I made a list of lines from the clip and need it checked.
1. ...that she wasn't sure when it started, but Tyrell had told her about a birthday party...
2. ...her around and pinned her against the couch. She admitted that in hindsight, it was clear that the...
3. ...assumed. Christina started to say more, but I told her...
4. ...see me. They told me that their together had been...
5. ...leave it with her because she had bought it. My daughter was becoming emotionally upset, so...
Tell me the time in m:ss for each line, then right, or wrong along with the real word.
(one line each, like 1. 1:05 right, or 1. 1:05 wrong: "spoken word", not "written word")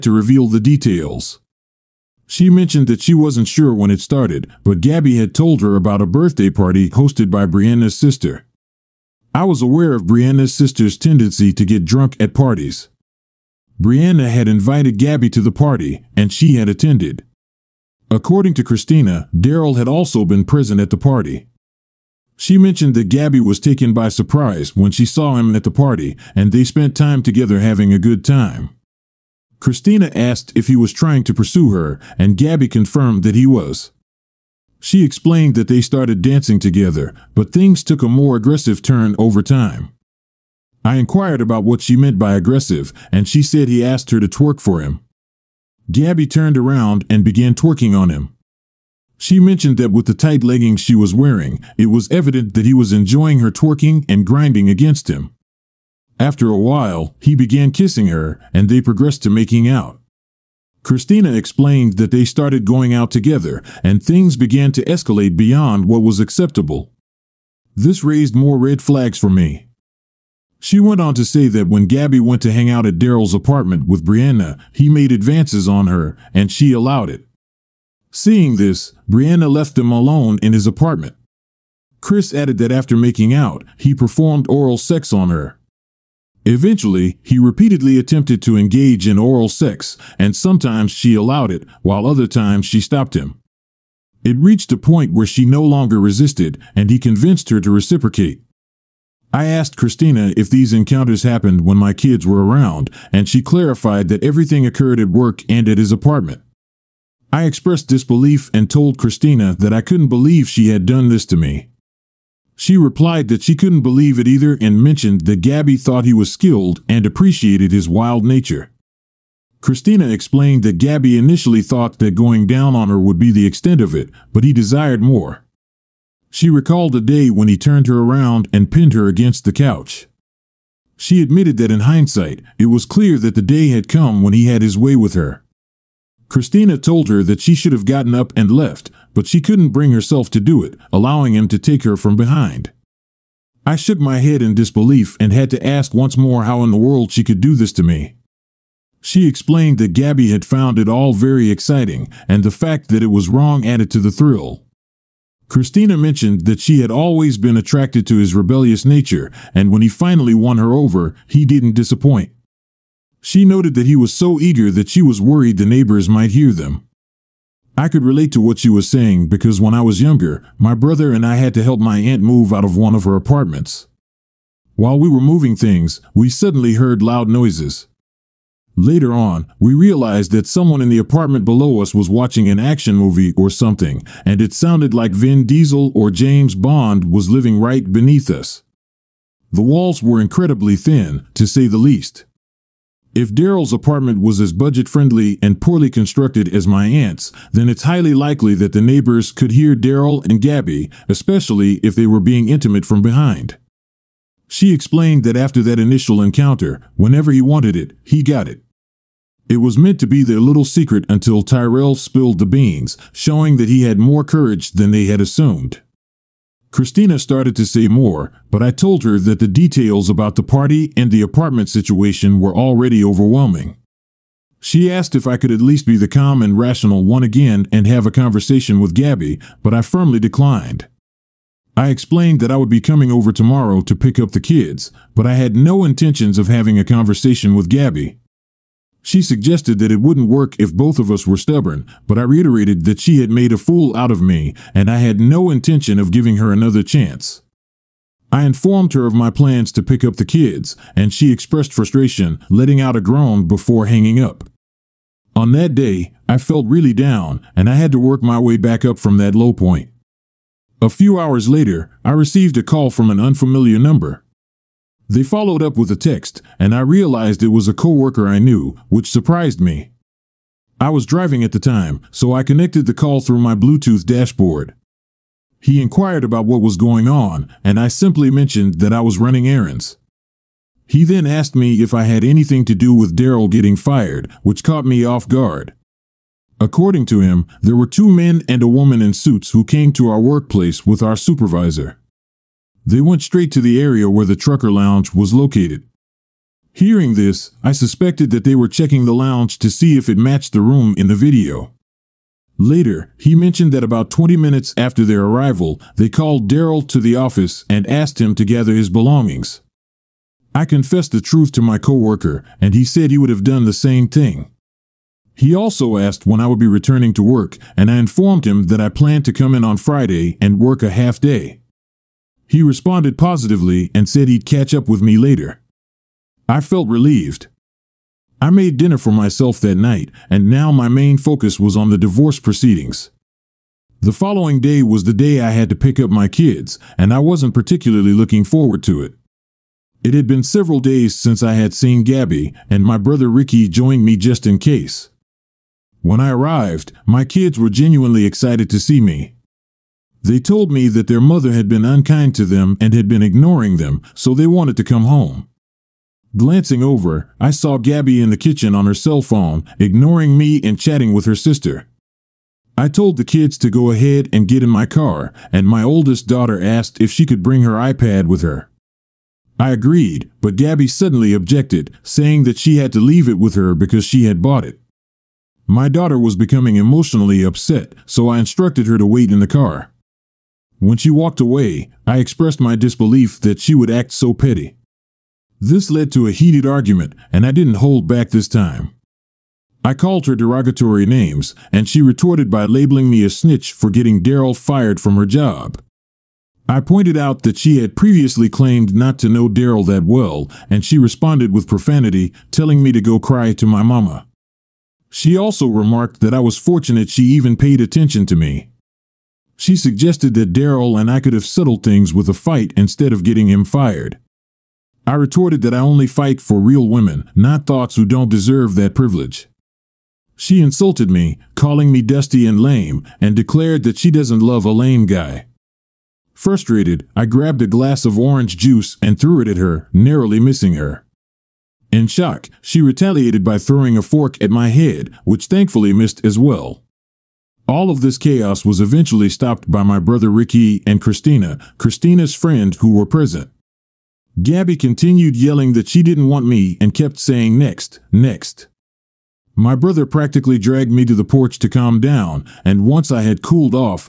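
1. 0:02 wrong: "Gabby", not "Tyrell"
2. 2:07 right
3. 3:35 right
4. 5:48 wrong: "mother", not "together"
5. 6:12 right.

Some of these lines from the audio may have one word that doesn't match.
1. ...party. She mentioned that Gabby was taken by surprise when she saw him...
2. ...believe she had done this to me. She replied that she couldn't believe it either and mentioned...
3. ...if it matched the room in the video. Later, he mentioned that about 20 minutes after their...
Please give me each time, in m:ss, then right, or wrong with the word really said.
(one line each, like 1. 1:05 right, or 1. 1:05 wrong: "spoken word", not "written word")
1. 0:20 right
2. 1:50 right
3. 4:59 right.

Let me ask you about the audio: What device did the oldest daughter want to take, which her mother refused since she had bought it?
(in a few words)
iPad.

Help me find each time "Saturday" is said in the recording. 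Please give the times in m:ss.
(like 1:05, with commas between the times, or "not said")
not said.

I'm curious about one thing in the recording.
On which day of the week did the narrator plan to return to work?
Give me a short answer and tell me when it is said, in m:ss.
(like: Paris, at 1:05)
Friday, at 5:19.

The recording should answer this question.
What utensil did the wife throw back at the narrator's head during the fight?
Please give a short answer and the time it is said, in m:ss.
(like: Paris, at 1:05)
fork, at 7:14.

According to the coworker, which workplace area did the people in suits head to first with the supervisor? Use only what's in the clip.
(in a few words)
trucker lounge.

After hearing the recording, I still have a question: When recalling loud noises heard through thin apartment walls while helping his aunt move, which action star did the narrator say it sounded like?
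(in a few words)
Vin Diesel.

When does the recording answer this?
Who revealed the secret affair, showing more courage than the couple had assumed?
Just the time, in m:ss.
3:31.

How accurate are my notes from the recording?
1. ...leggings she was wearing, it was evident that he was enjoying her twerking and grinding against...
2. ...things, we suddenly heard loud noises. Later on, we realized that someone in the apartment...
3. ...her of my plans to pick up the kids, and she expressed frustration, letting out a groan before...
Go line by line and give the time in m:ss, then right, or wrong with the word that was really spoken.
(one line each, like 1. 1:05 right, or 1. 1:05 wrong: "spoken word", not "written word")
1. 0:50 right
2. 2:55 right
3. 4:08 right.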